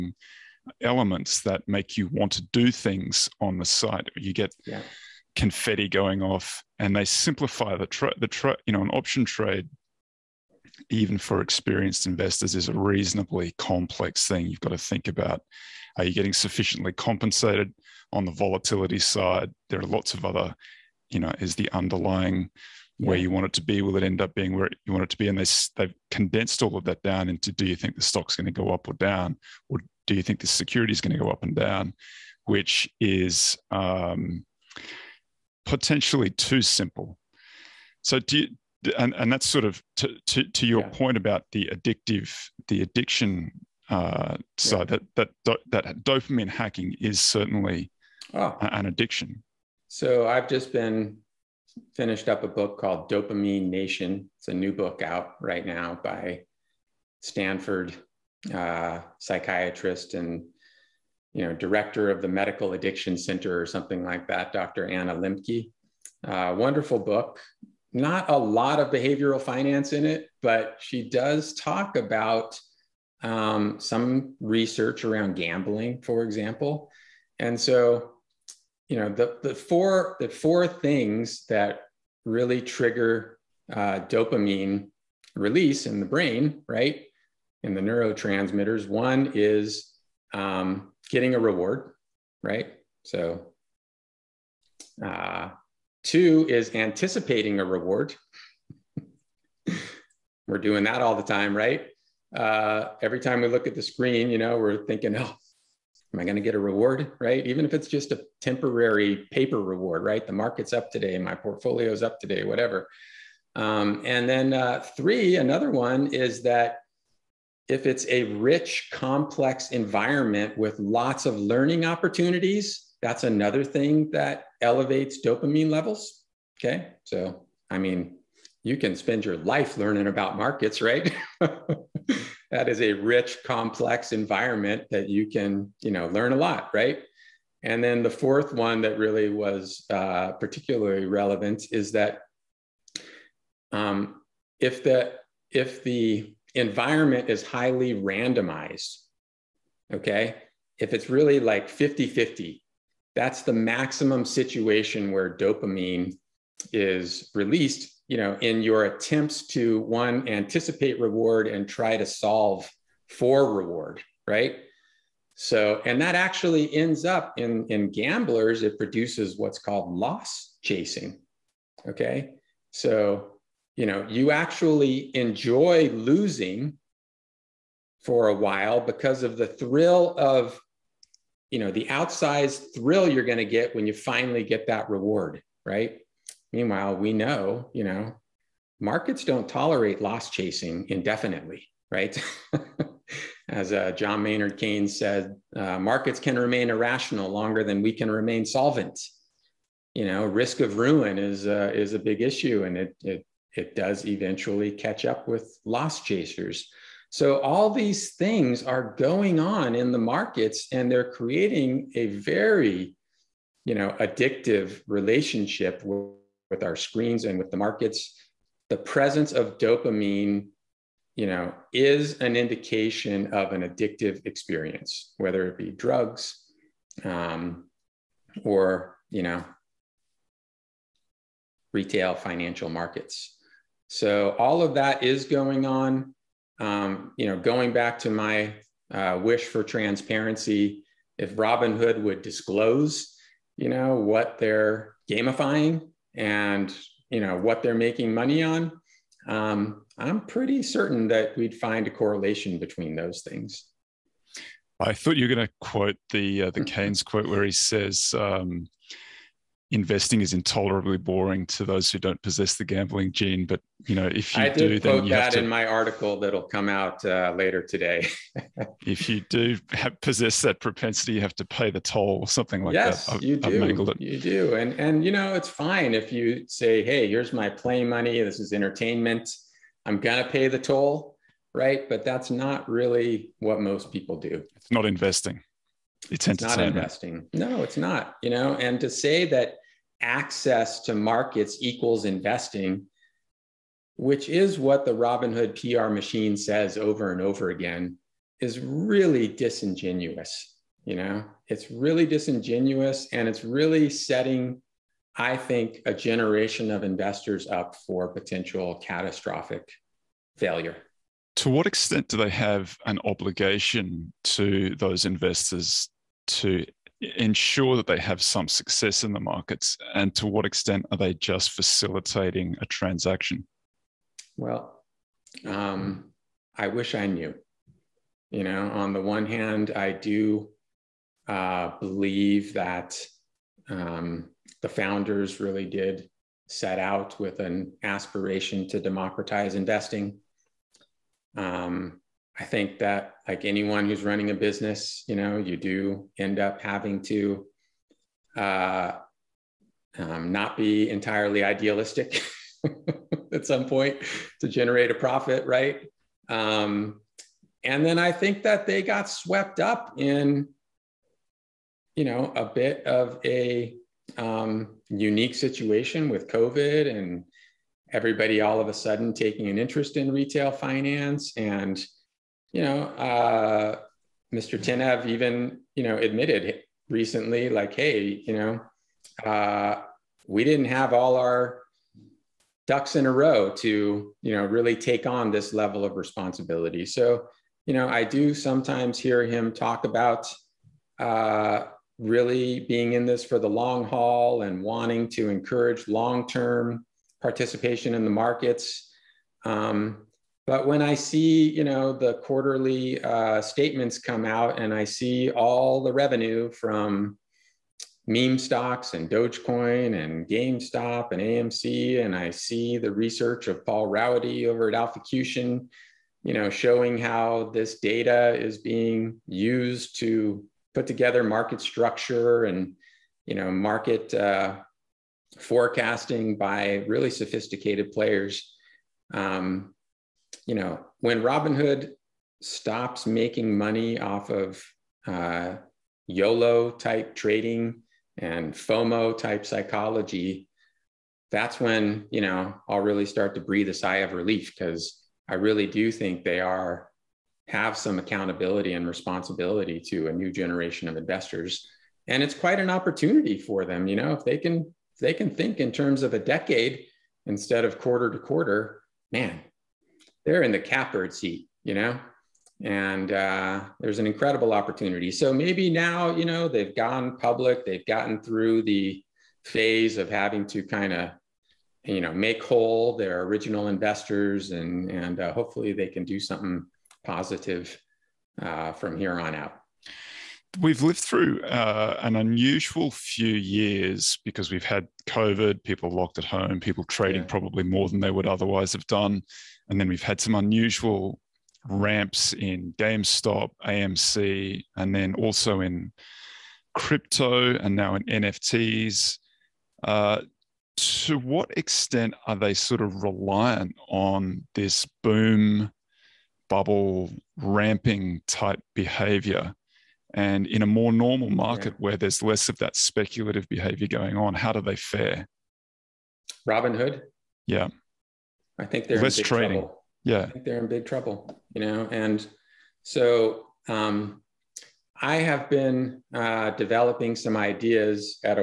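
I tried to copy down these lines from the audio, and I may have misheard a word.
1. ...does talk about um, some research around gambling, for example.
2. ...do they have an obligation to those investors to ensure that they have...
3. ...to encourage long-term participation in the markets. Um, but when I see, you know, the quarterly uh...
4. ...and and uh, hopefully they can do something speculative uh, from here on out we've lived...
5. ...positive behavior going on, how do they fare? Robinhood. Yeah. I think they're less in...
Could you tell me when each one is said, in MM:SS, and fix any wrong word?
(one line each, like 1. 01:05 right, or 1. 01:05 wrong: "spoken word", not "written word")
1. 01:11 right
2. 05:12 right
3. 06:35 right
4. 07:54 wrong: "positive", not "speculative"
5. 08:32 wrong: "speculative", not "positive".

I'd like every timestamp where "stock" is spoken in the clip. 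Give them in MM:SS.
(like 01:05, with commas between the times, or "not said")
00:28, 06:48.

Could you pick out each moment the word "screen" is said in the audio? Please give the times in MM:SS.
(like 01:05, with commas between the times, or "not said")
01:43, 03:36.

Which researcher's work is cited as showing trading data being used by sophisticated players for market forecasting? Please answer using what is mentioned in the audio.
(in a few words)
Paul Rowady.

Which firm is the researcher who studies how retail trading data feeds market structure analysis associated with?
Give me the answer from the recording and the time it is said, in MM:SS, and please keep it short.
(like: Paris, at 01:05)
Alphacution, at 06:54.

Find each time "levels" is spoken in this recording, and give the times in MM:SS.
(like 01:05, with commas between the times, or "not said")
02:05, 06:25.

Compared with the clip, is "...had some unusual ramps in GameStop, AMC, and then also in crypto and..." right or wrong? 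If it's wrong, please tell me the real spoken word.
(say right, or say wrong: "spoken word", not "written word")
right.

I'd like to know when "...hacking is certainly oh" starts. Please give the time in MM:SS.
00:46.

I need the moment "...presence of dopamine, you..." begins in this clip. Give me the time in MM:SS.
03:38.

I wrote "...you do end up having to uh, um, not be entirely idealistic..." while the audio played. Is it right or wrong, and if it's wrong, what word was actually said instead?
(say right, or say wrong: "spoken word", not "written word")
right.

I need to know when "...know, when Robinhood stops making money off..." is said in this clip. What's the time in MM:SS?
07:10.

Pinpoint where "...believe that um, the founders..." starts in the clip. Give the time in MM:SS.
05:31.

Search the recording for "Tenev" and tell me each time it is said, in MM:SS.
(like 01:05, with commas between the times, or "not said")
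06:14.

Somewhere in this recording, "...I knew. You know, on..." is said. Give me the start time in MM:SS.
05:26.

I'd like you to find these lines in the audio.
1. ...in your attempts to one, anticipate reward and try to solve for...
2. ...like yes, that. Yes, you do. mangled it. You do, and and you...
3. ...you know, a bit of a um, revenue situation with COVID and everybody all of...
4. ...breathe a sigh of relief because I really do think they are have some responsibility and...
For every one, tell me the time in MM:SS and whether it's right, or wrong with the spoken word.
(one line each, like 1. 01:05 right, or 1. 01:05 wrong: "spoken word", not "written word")
1. 02:38 right
2. 04:32 right
3. 06:01 wrong: "unique", not "revenue"
4. 07:23 wrong: "accountability", not "responsibility".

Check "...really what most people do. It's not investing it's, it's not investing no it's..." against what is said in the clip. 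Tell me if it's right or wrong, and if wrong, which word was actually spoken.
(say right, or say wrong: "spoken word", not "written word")
right.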